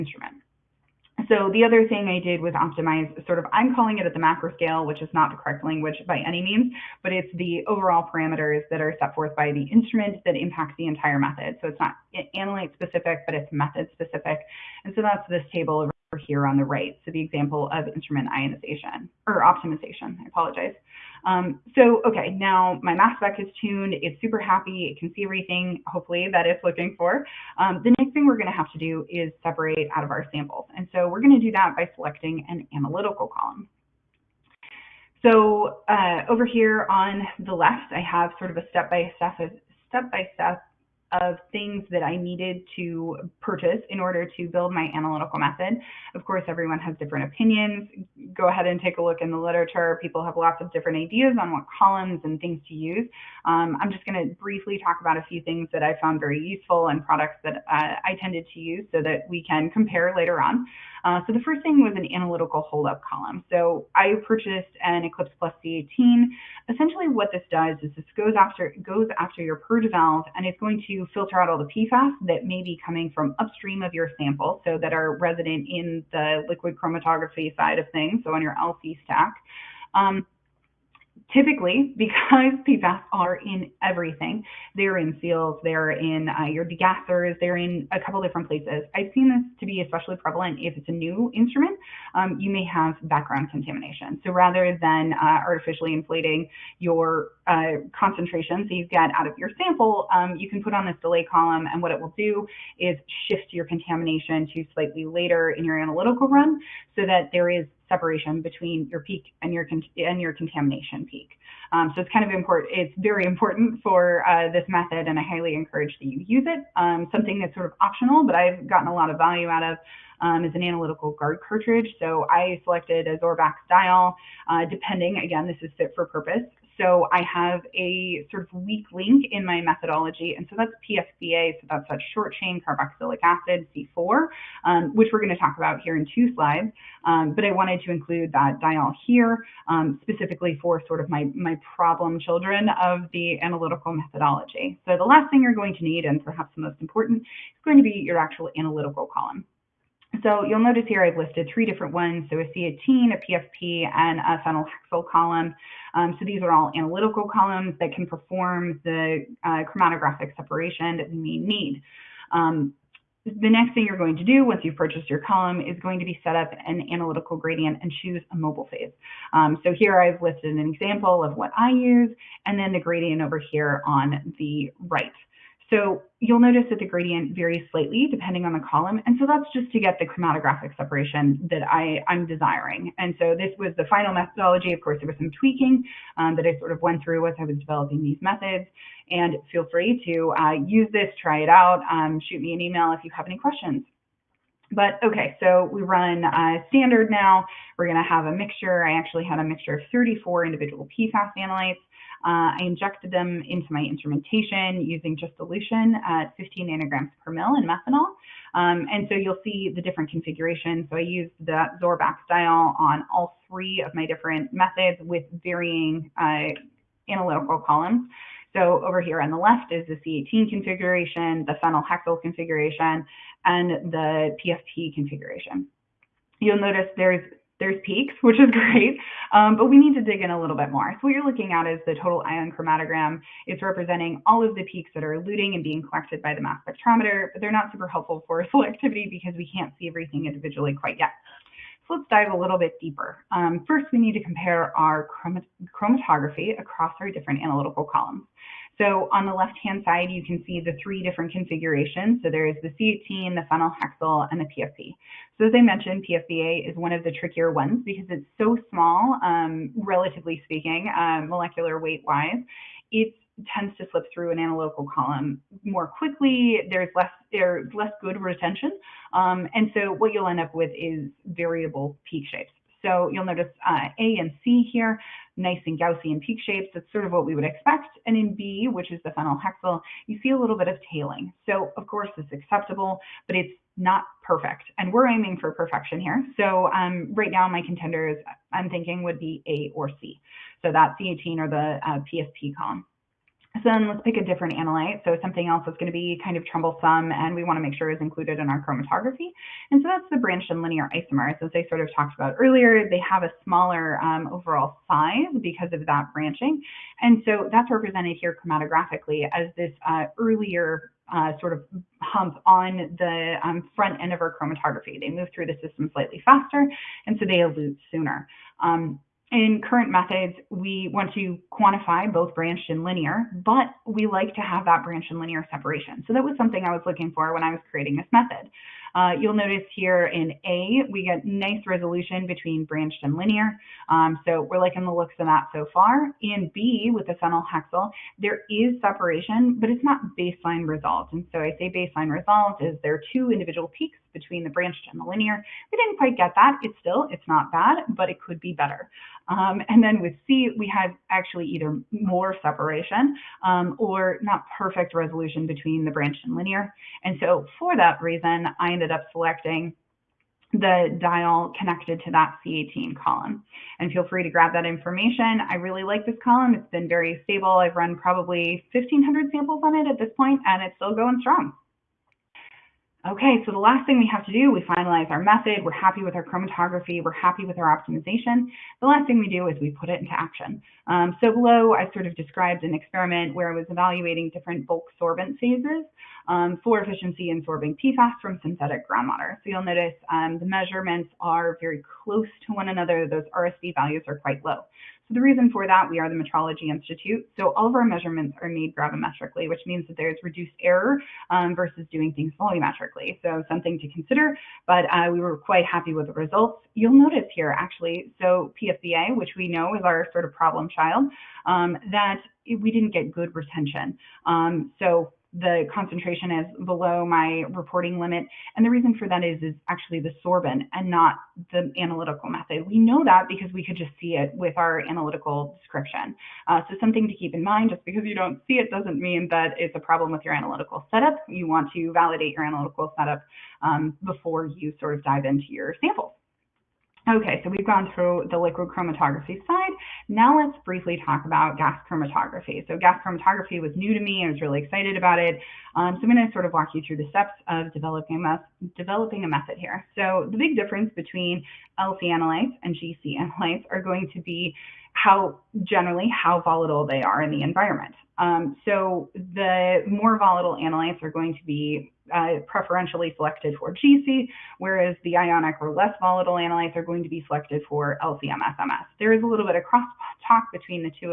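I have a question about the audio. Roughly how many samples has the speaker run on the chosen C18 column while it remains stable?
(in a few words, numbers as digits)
1,500.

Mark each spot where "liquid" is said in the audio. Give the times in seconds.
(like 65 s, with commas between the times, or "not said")
76 s, 438 s.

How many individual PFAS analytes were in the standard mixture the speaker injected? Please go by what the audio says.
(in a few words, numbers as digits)
34.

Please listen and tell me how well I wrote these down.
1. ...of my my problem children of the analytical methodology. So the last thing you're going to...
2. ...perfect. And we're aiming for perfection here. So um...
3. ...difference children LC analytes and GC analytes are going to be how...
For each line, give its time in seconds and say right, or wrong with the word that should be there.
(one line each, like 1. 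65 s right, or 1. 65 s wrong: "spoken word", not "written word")
1. 140 s right
2. 284 s right
3. 450 s wrong: "between", not "children".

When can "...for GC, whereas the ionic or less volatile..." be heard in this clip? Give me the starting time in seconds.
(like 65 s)
463 s.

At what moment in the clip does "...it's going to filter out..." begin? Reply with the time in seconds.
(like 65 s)
70 s.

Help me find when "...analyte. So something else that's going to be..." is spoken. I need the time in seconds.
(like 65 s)
294 s.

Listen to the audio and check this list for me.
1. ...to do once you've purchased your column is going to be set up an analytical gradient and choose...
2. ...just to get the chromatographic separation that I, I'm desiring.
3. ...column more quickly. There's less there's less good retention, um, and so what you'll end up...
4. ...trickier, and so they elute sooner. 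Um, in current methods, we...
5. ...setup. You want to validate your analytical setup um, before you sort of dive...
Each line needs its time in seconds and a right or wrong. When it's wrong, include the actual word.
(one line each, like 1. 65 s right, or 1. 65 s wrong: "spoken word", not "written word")
1. 164 s right
2. 179 s right
3. 264 s right
4. 316 s wrong: "faster", not "trickier"
5. 430 s right.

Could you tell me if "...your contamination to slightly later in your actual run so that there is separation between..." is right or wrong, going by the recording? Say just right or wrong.
wrong.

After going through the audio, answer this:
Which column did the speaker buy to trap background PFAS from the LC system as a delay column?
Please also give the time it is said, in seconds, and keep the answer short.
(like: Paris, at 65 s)
Eclipse Plus C18, at 65 s.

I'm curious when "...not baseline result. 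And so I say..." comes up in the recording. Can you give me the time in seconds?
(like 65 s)
339 s.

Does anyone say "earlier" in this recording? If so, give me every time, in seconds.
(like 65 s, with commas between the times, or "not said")
302 s, 310 s.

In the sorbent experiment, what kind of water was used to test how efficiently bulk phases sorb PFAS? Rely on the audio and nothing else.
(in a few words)
synthetic groundwater.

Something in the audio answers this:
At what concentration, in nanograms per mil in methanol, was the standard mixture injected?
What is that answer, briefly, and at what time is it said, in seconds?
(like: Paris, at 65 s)
15, at 206 s.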